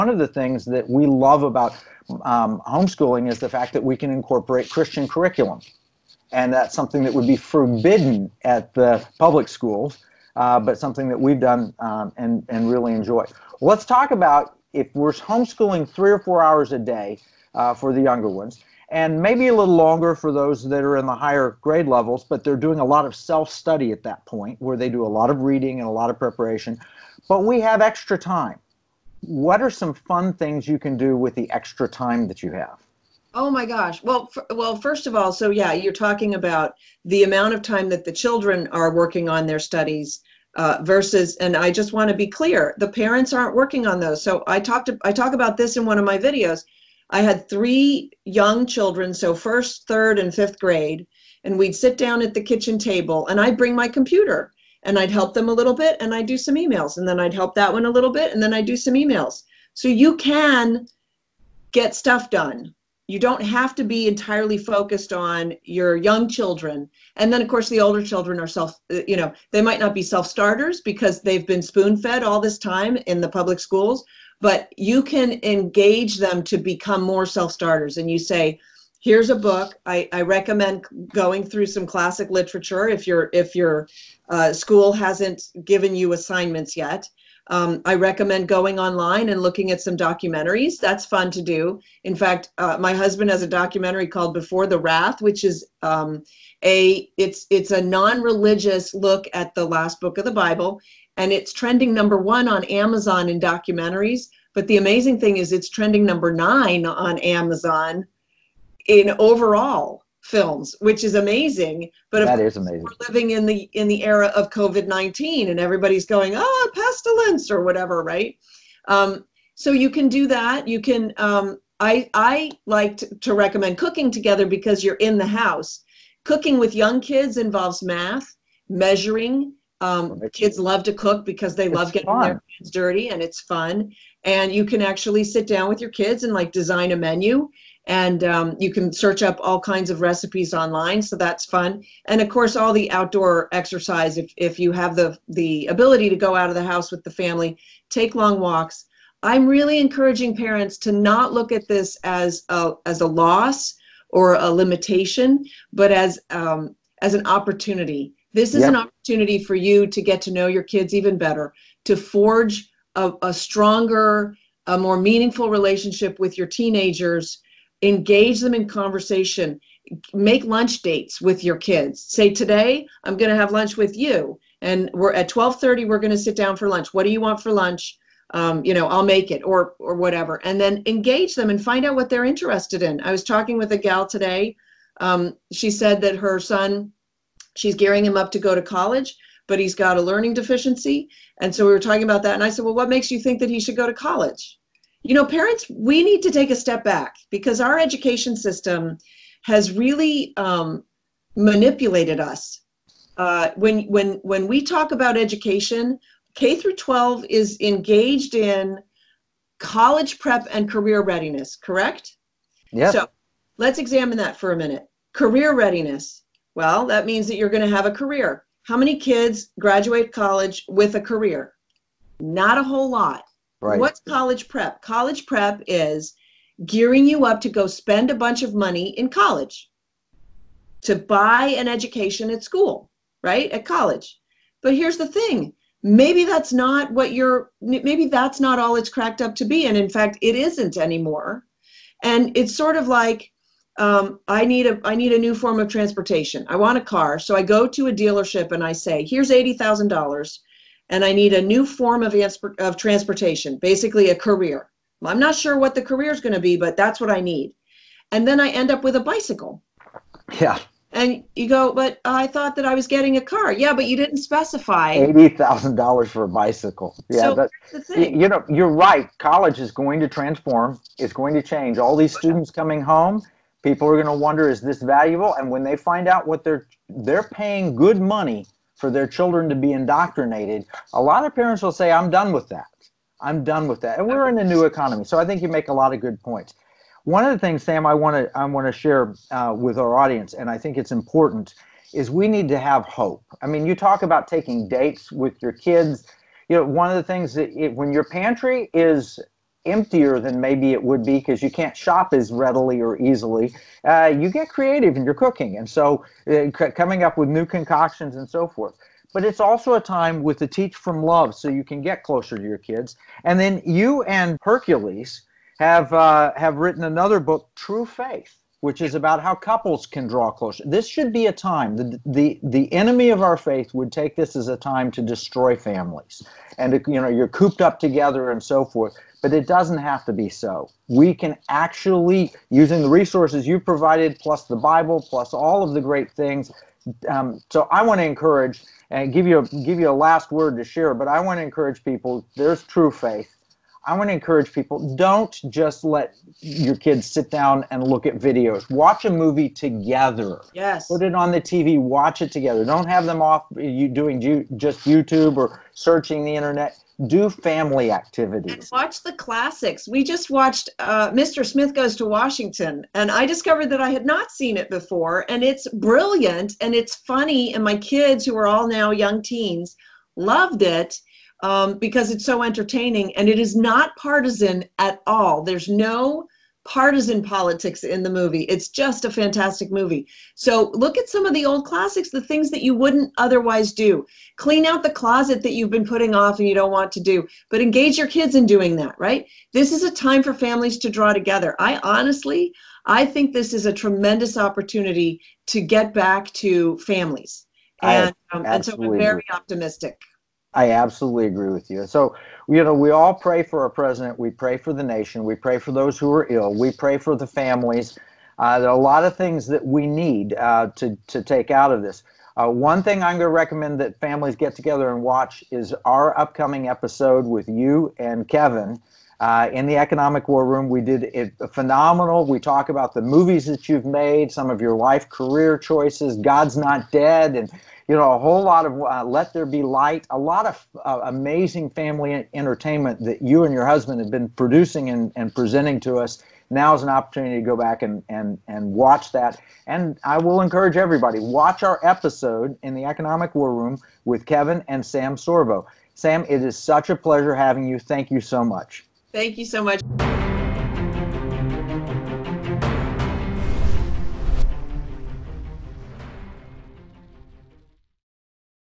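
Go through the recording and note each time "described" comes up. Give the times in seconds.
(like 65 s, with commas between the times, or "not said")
not said.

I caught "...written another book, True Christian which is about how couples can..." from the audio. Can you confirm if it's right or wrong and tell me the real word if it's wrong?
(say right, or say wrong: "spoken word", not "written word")
wrong: "Faith", not "Christian".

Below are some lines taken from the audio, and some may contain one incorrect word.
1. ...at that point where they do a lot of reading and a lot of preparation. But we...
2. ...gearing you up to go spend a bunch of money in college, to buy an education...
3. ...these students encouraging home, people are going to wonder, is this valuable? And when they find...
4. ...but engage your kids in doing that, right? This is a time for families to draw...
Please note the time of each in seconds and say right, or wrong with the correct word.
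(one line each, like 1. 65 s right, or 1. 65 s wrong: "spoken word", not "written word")
1. 23 s right
2. 226 s right
3. 271 s wrong: "coming", not "encouraging"
4. 387 s right.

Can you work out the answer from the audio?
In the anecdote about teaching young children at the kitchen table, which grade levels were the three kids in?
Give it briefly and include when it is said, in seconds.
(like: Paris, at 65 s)
first, third, and fifth, at 49 s.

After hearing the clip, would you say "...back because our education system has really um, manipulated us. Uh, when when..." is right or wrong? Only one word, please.
right.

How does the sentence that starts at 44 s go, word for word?
So I talked, I talk about this in one of my videos.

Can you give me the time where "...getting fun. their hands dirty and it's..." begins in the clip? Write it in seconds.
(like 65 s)
131 s.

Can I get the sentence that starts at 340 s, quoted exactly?
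But I want to encourage people.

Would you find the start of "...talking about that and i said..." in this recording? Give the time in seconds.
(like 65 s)
191 s.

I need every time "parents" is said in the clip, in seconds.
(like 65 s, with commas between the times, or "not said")
42 s, 150 s, 195 s, 281 s.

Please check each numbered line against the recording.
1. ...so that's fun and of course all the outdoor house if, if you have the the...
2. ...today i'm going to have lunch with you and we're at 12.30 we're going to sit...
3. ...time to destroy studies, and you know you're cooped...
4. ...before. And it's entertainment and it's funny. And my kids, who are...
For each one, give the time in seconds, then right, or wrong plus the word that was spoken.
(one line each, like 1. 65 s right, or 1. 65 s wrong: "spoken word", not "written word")
1. 141 s wrong: "exercise", not "house"
2. 172 s right
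3. 324 s wrong: "families", not "studies"
4. 364 s wrong: "brilliant", not "entertainment".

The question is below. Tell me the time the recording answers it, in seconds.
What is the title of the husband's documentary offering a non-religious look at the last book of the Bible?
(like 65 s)
94 s.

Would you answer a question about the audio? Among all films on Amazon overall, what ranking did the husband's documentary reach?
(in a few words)
9.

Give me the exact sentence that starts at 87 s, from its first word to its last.
Um, I recommend going online and looking at some documentaries.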